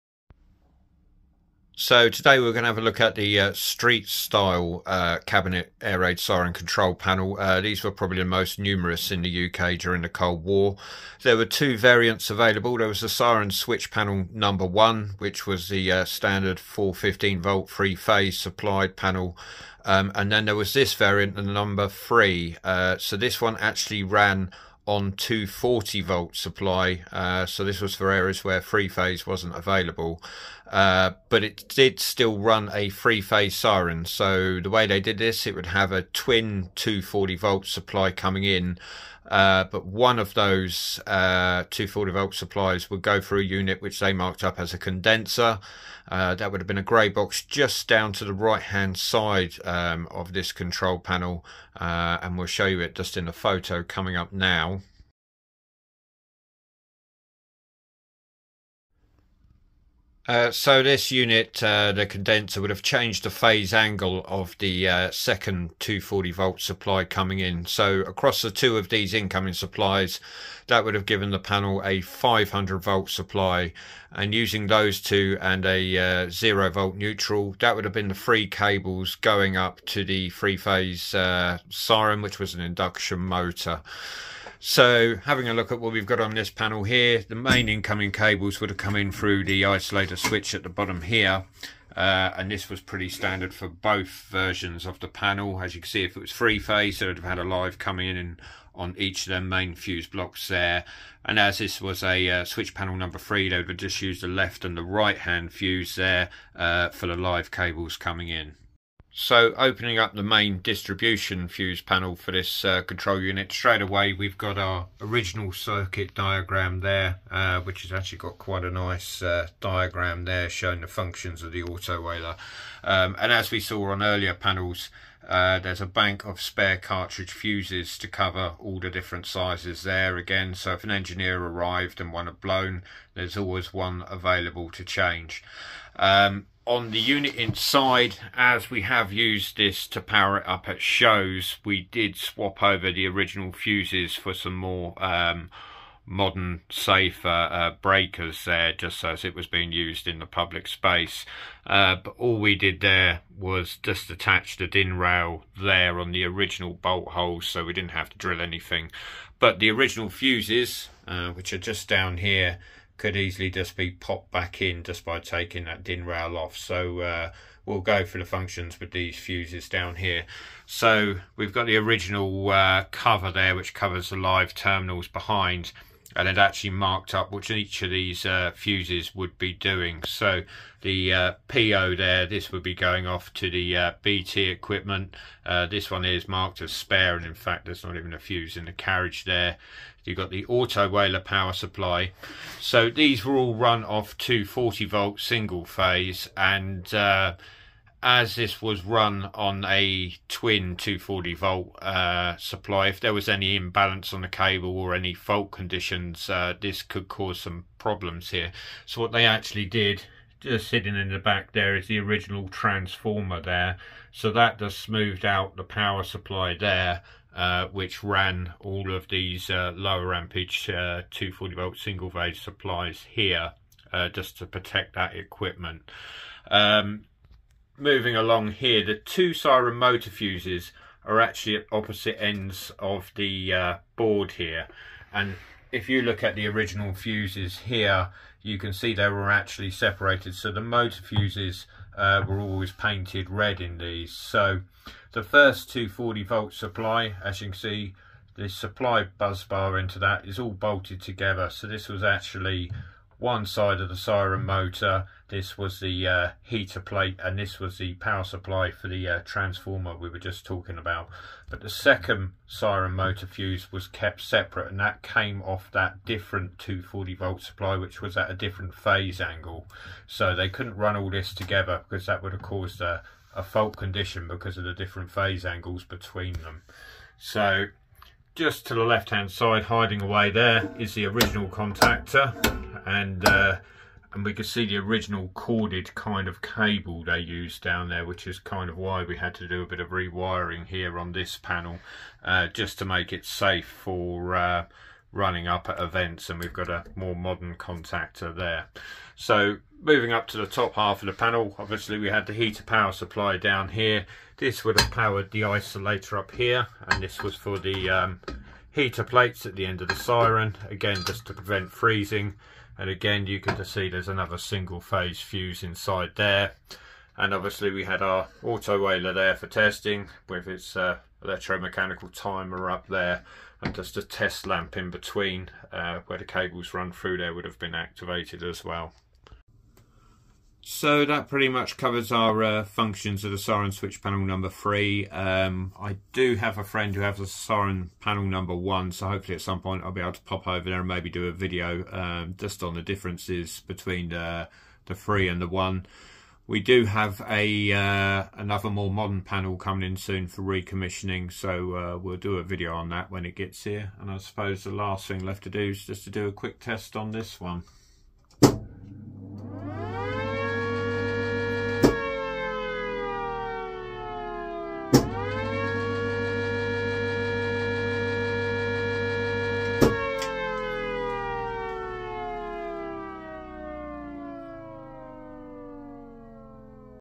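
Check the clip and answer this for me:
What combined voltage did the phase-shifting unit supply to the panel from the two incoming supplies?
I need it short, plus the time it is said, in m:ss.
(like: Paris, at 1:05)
500 volt, at 1:11.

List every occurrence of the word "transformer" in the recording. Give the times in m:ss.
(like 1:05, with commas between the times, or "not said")
3:32, 4:19.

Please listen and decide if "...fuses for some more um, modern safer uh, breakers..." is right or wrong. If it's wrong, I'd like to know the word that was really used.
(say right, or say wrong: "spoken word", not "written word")
right.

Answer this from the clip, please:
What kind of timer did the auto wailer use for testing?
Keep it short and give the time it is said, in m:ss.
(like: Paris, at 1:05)
electromechanical, at 5:21.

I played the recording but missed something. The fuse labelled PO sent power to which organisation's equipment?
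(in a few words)
BT.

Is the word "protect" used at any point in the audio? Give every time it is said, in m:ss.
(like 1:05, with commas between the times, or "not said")
3:44.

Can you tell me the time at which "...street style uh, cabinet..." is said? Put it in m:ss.
0:03.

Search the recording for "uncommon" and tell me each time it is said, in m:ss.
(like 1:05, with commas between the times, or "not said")
not said.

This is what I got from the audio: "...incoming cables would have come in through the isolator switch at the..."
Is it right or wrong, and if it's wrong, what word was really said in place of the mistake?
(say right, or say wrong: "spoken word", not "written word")
right.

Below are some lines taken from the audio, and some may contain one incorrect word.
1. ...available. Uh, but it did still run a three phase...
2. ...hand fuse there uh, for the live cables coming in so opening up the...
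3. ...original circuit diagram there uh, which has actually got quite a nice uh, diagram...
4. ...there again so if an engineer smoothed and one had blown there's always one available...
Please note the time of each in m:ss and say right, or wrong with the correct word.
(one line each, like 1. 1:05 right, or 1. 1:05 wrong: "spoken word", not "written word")
1. 0:29 right
2. 1:45 right
3. 1:55 right
4. 2:09 wrong: "arrived", not "smoothed".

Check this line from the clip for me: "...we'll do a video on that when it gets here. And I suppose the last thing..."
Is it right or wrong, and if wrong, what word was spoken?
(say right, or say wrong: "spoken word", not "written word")
right.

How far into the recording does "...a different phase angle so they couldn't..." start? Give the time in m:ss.
4:28.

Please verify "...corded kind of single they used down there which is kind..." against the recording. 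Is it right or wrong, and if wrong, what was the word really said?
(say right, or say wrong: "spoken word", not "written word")
wrong: "cable", not "single".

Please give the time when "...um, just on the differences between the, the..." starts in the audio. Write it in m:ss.
5:41.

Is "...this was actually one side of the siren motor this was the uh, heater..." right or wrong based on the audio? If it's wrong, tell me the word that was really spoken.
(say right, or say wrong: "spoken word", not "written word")
right.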